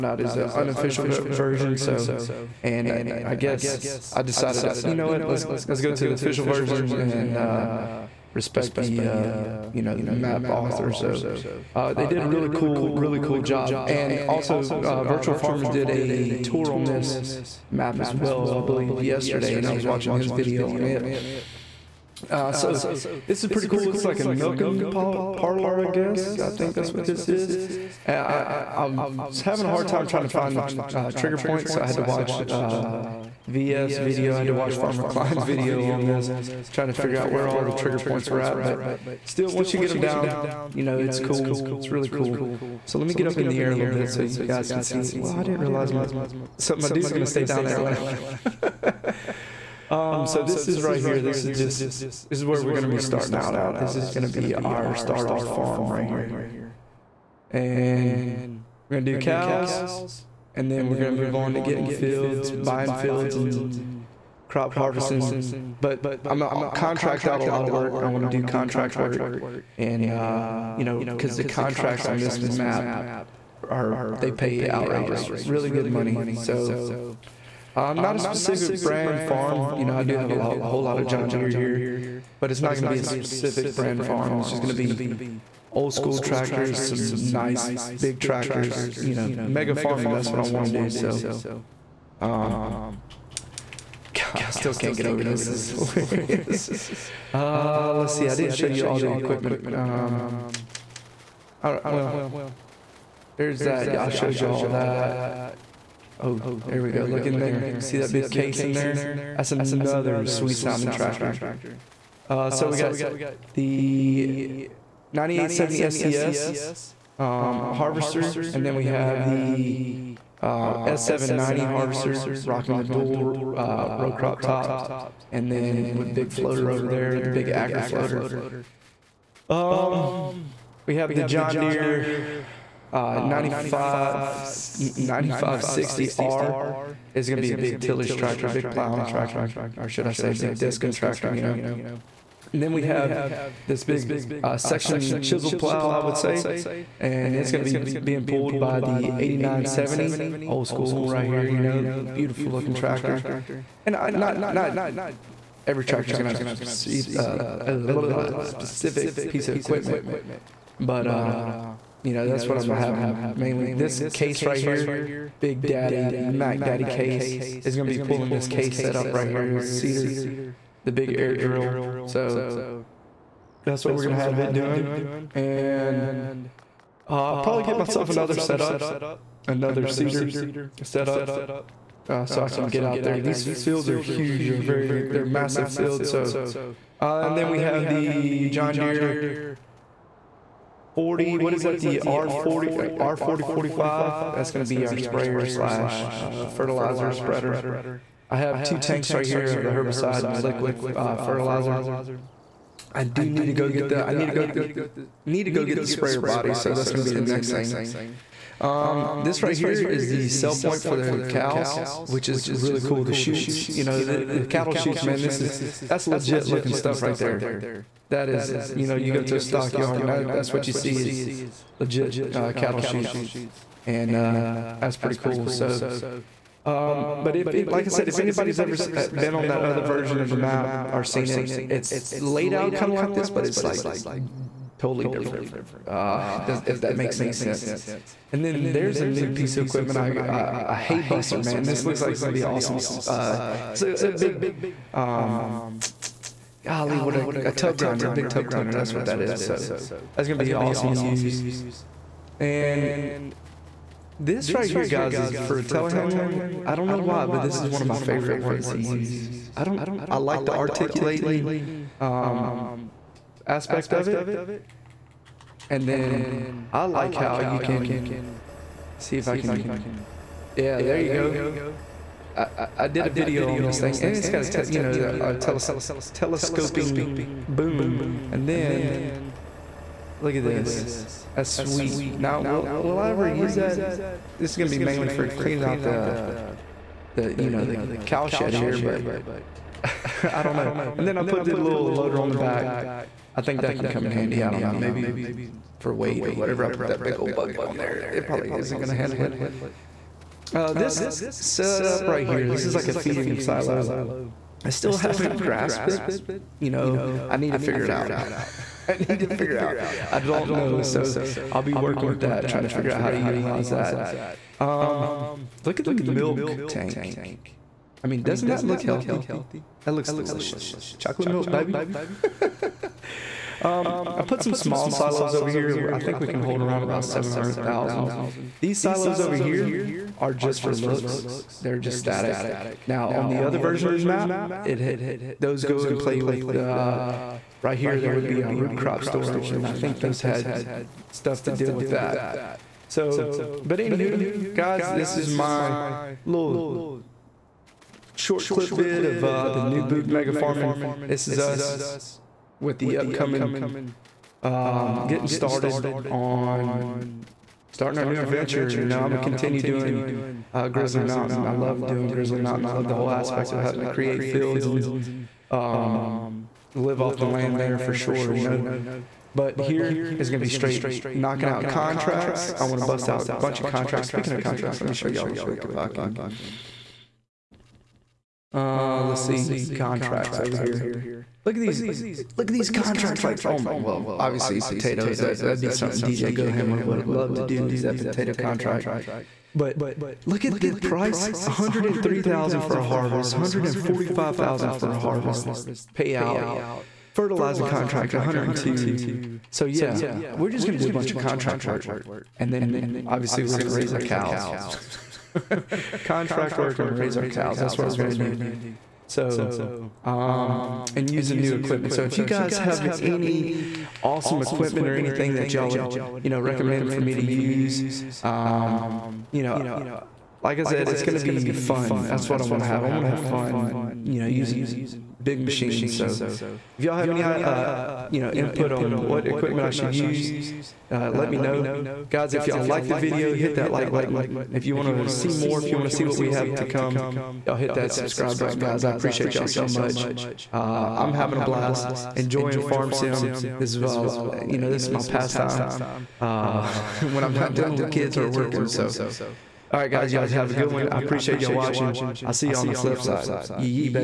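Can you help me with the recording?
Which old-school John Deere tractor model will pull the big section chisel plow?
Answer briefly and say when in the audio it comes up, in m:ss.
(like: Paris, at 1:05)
8970, at 2:29.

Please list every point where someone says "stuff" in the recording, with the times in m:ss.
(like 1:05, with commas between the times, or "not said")
3:36, 5:41.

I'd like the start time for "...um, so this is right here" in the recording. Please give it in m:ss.
0:49.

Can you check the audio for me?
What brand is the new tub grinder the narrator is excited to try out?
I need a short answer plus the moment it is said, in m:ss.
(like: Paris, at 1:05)
Haybuster, at 4:00.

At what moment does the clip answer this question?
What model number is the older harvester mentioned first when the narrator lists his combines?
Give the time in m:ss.
1:55.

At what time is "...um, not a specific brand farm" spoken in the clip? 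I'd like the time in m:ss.
1:17.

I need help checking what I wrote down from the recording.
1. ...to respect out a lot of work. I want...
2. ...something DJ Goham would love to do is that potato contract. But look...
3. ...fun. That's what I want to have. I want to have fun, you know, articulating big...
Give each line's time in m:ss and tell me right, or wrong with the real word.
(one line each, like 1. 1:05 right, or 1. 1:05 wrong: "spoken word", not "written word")
1. 1:06 wrong: "contract", not "respect"
2. 6:25 right
3. 7:01 wrong: "using", not "articulating".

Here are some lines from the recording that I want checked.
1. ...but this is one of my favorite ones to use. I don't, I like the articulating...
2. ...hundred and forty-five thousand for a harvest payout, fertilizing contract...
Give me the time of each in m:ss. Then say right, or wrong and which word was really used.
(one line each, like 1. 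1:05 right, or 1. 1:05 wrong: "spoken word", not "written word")
1. 4:17 right
2. 6:33 right.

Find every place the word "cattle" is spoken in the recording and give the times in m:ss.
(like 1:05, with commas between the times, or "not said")
3:34, 3:42.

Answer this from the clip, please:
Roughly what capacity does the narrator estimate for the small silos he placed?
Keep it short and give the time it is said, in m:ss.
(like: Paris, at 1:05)
700,000, at 5:27.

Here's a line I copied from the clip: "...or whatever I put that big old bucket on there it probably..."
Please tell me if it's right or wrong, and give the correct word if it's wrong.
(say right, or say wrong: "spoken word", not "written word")
right.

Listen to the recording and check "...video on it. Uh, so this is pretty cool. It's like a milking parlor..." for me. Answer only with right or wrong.
right.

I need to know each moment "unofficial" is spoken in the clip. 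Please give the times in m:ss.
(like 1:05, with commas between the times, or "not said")
0:00.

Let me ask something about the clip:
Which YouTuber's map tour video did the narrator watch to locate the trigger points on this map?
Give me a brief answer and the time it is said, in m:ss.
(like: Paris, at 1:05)
Virtual Farmer, at 0:15.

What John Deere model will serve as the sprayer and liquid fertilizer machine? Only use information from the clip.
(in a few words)
R4045.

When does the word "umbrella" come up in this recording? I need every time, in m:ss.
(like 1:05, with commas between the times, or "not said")
not said.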